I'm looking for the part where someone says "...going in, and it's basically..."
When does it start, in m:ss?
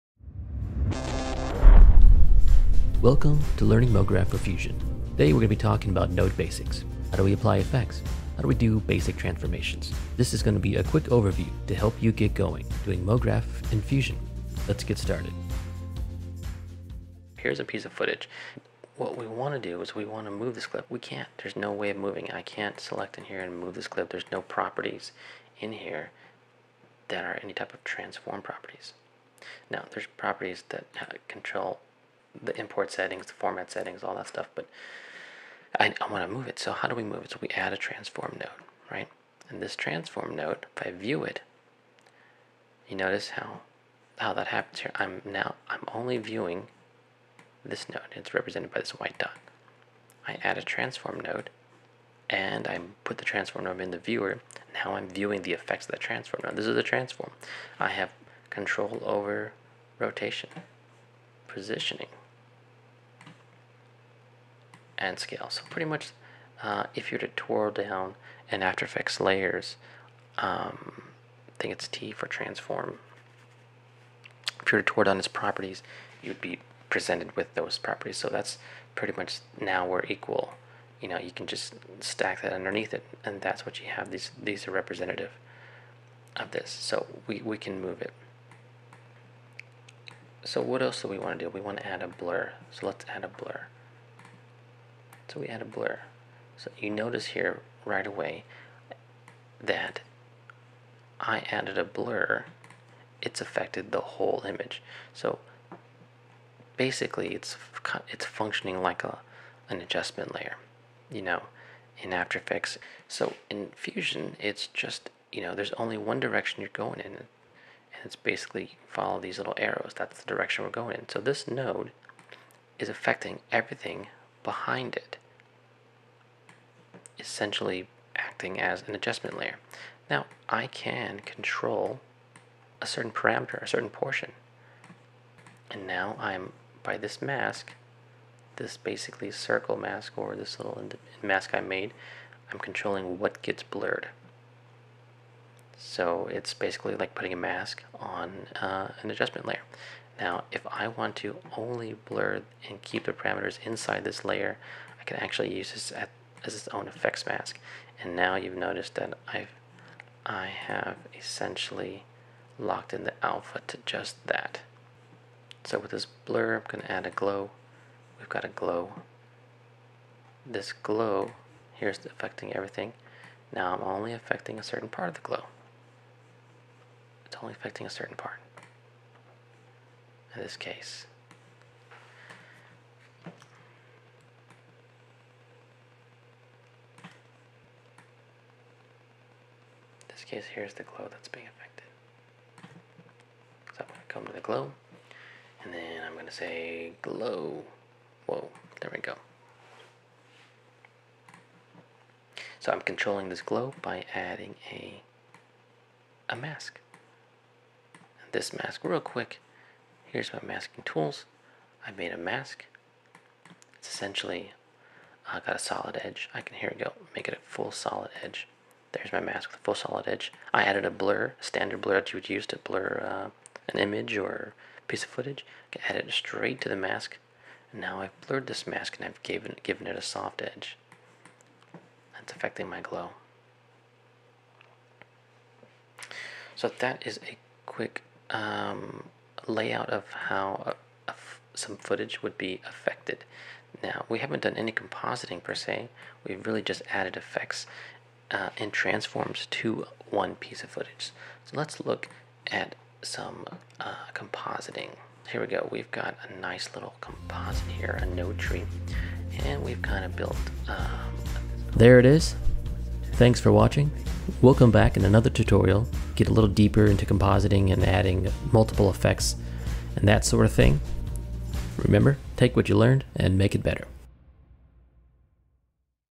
1:56.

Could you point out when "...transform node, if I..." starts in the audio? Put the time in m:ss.
0:39.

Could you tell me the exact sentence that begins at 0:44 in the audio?
I'm now I'm only viewing this node.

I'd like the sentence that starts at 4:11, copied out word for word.
So let's look at some uh, compositing.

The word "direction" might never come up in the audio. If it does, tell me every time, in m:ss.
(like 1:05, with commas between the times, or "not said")
1:56, 2:00.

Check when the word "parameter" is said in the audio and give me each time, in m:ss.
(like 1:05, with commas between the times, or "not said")
2:13, 2:33.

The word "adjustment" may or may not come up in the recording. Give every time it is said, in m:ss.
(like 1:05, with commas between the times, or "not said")
1:49, 2:08, 2:29.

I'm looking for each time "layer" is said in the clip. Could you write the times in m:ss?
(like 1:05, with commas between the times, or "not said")
1:09, 1:50, 2:09, 2:29, 2:34.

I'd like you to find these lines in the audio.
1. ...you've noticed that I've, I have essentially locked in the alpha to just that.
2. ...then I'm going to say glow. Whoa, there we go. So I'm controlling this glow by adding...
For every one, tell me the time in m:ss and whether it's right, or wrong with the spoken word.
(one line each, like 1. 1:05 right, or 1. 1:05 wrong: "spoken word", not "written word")
1. 2:38 right
2. 3:15 right.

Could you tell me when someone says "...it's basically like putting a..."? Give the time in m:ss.
2:26.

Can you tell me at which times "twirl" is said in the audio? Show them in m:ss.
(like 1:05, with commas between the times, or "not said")
1:07, 1:14.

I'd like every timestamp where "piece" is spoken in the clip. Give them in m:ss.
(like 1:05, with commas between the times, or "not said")
0:17, 3:44, 4:10.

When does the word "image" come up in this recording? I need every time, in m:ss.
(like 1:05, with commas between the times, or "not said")
1:44, 3:43.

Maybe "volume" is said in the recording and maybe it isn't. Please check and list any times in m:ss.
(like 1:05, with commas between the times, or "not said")
not said.